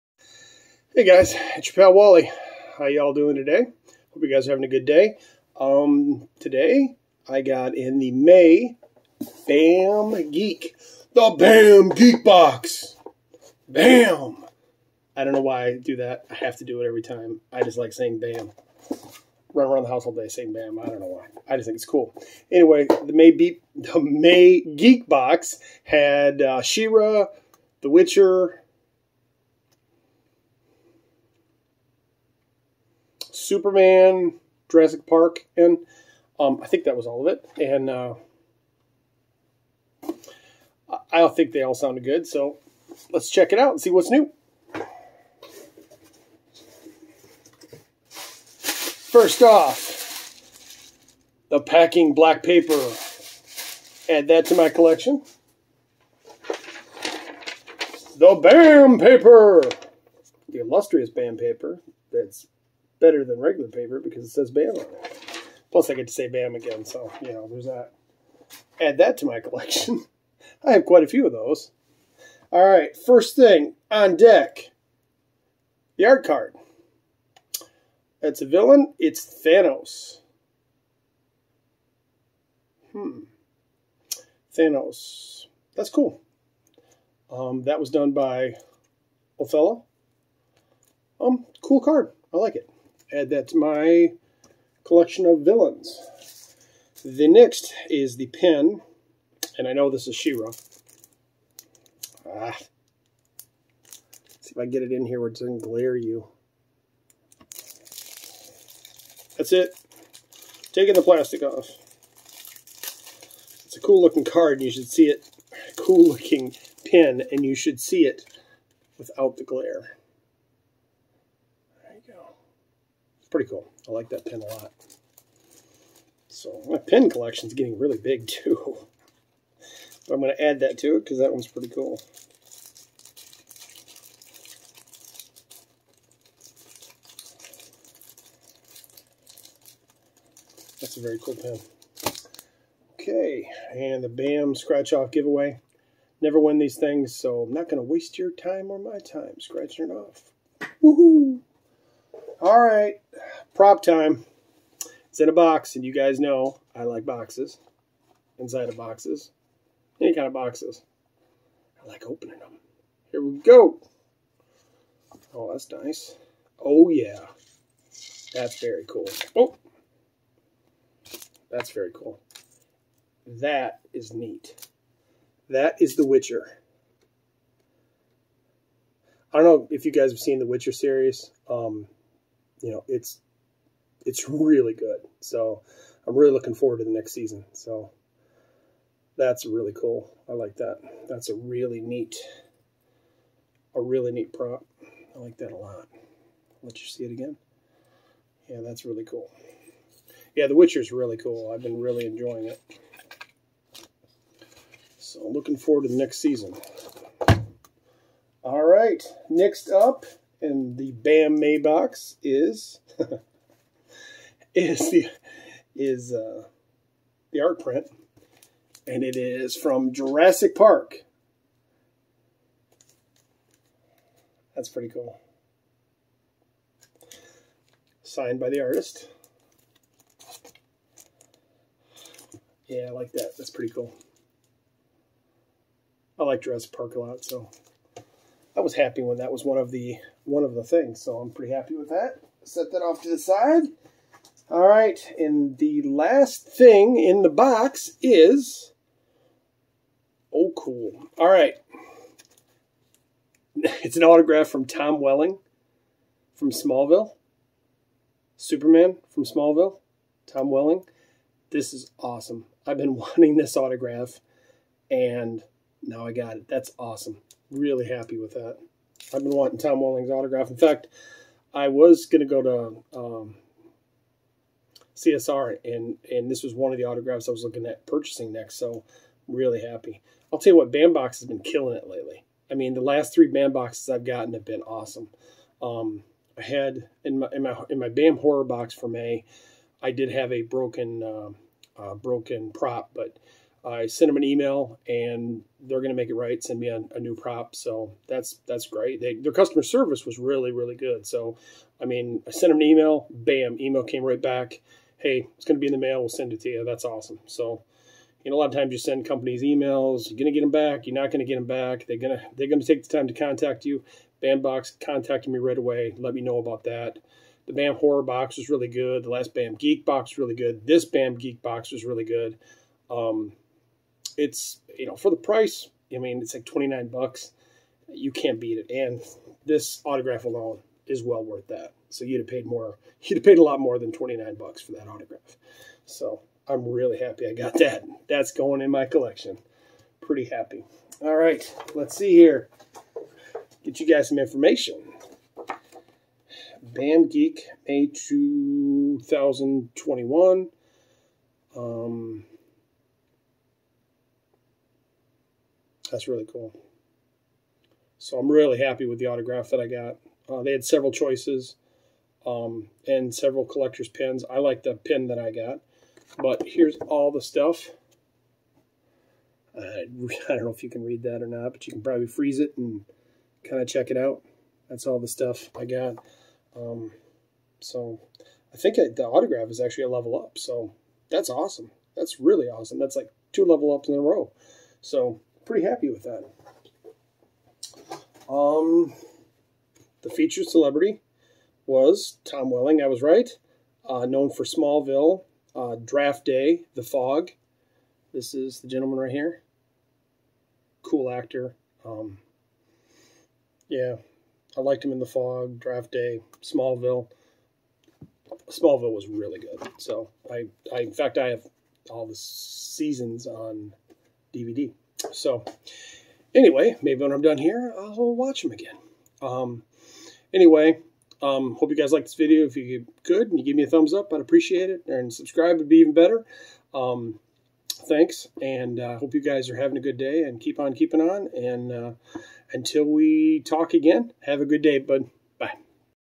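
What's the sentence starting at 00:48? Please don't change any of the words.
First off, the packing black paper.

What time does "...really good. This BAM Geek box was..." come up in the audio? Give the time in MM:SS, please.
05:20.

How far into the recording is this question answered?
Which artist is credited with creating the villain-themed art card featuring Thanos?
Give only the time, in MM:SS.
01:29.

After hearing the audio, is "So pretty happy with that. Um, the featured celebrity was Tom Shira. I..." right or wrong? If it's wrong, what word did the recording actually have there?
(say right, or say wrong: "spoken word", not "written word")
wrong: "Welling", not "Shira".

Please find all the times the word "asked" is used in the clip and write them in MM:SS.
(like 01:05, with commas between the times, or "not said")
not said.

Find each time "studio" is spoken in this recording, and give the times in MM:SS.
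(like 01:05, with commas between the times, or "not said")
not said.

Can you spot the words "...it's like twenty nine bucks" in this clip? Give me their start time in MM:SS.
05:26.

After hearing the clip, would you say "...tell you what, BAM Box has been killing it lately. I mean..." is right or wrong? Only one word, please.
right.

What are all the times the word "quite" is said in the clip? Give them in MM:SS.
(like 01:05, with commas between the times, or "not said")
01:10.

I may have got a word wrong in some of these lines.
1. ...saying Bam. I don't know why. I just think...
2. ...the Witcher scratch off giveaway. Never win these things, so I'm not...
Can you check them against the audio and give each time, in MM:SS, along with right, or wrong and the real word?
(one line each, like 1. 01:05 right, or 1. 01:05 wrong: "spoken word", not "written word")
1. 00:20 right
2. 02:24 wrong: "BAM", not "Witcher".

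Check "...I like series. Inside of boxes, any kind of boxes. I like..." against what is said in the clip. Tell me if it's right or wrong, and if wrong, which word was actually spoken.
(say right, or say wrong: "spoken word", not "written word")
wrong: "boxes", not "series".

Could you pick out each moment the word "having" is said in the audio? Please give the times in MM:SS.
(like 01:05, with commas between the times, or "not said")
00:04, 07:09.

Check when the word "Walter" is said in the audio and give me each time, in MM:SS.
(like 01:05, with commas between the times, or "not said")
not said.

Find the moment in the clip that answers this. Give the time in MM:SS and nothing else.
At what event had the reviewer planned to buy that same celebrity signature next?
04:34.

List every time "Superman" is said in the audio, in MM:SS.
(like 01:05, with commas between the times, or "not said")
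00:33, 04:18.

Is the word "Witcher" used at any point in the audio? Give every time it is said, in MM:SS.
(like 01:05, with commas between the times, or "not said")
00:27, 02:56, 03:00, 03:20.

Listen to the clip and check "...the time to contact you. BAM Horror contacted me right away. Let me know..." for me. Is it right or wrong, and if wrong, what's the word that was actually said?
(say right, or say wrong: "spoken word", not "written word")
wrong: "Box", not "Horror".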